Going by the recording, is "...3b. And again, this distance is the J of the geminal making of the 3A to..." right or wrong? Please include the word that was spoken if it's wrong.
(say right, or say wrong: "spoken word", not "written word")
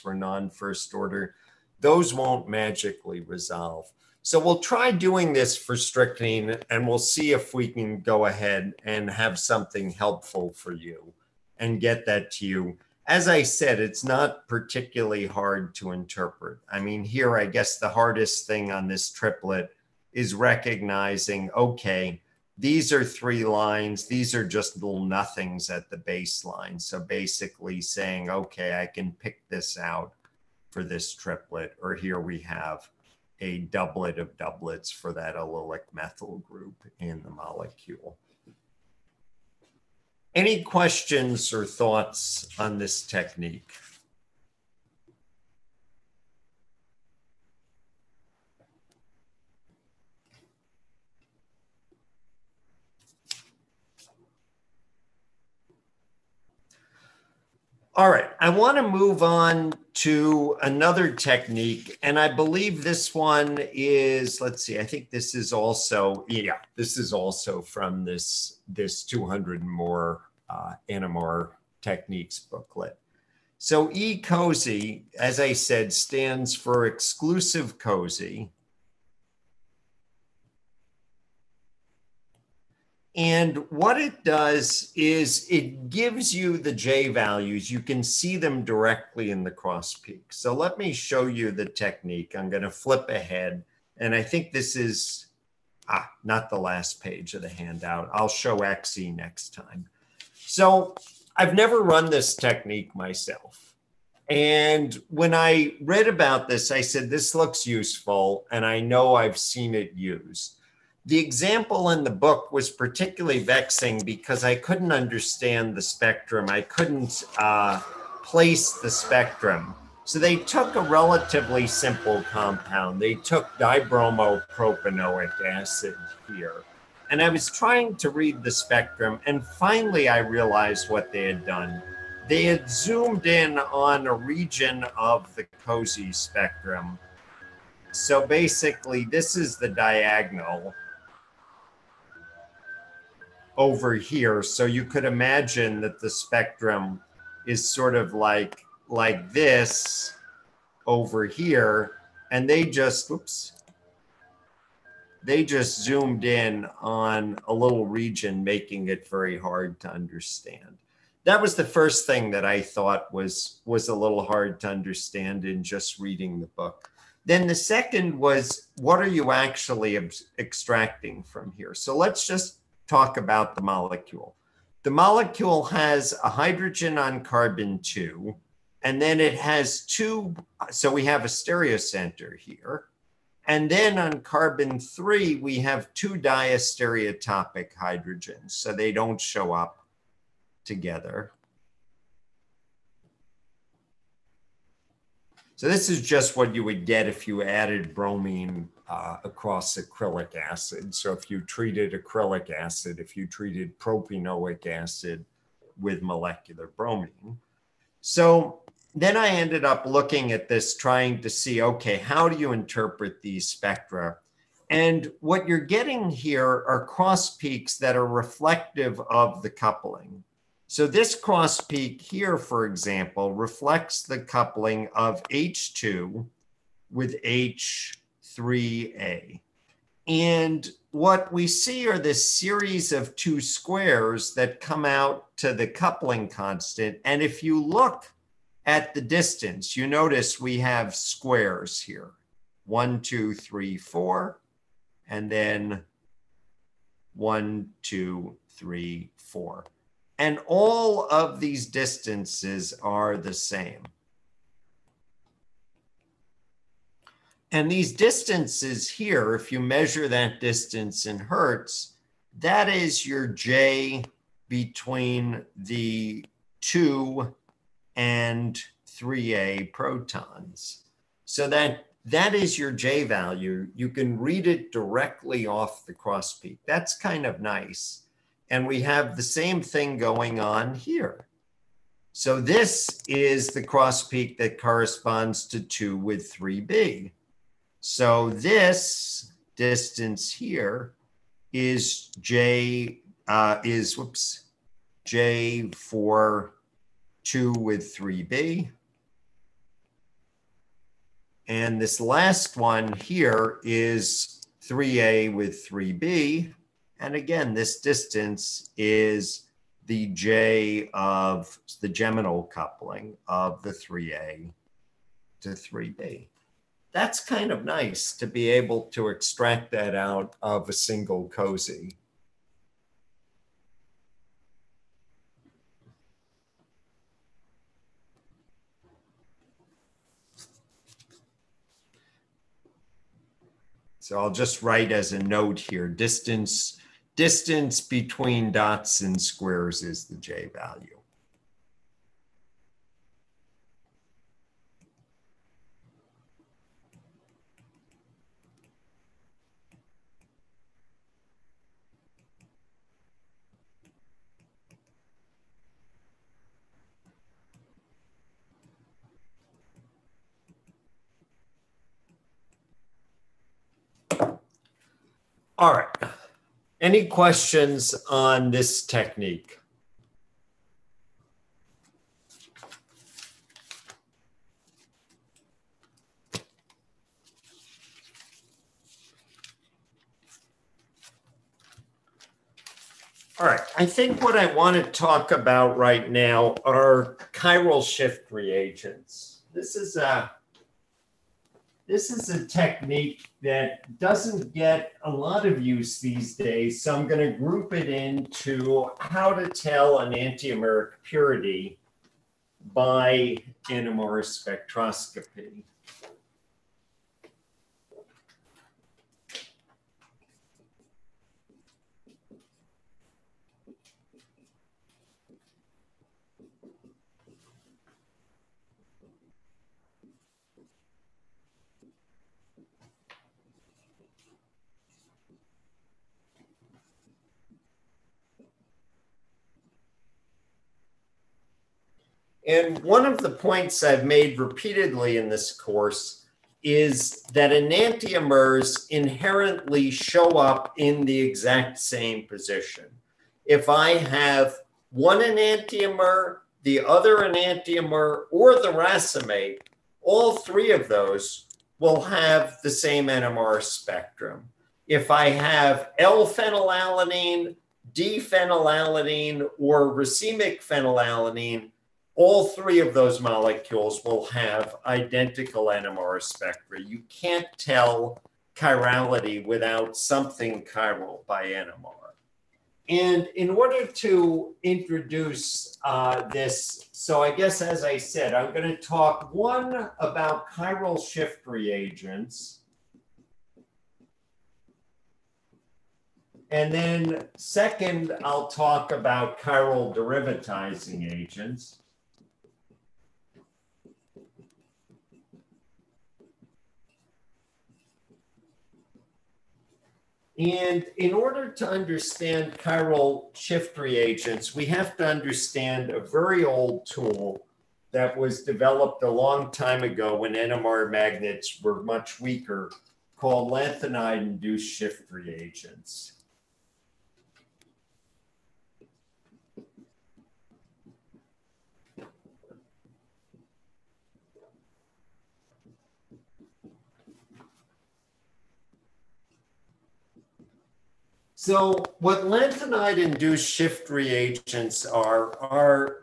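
wrong: "coupling", not "making".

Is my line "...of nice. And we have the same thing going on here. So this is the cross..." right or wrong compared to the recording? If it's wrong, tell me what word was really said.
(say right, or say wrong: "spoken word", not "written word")
right.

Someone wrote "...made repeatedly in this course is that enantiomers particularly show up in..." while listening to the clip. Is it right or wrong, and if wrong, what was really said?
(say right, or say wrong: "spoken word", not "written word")
wrong: "inherently", not "particularly".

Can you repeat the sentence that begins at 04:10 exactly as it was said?
And all of these distances are the same.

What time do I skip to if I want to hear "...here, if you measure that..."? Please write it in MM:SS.
04:18.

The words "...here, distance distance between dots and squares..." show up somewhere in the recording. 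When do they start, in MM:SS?
05:35.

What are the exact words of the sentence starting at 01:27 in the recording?
You can see them directly in the cross peak.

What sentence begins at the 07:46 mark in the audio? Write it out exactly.
You can't tell chirality without something chiral by NMR.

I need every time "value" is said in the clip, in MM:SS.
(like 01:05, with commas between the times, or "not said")
01:27, 04:33, 05:40.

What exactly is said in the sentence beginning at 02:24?
So you could imagine that the spectrum is sort of like like this over here.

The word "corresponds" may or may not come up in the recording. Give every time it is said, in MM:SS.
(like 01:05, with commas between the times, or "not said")
04:44.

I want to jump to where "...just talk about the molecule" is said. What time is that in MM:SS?
02:52.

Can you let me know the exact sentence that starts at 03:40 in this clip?
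So this cross peak here, for example, reflects the coupling of H2 with H3A.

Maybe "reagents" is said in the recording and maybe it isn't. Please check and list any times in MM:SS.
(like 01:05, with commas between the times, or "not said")
06:28, 08:01, 08:23, 08:35, 08:53.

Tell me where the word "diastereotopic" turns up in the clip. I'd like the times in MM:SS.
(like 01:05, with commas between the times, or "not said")
03:06.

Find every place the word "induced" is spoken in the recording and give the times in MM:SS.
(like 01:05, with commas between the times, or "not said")
08:33, 08:52.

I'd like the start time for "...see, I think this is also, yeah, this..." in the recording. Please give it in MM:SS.
01:04.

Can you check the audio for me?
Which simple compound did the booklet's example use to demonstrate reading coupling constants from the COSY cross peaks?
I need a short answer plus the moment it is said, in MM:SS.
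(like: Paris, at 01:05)
dibromopropanoic acid, at 02:03.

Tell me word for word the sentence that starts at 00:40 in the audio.
Any questions or thoughts on this technique?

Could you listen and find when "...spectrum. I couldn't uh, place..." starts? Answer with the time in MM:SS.
01:55.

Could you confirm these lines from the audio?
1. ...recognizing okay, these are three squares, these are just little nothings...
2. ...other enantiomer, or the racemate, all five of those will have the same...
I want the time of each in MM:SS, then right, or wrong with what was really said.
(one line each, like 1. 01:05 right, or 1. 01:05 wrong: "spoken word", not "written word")
1. 00:20 wrong: "lines", not "squares"
2. 07:26 wrong: "three", not "five".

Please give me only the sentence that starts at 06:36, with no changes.
So I'm going to group it into how to tell an enantiomeric purity by NMR spectroscopy.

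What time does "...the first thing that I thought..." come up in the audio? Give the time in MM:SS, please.
02:41.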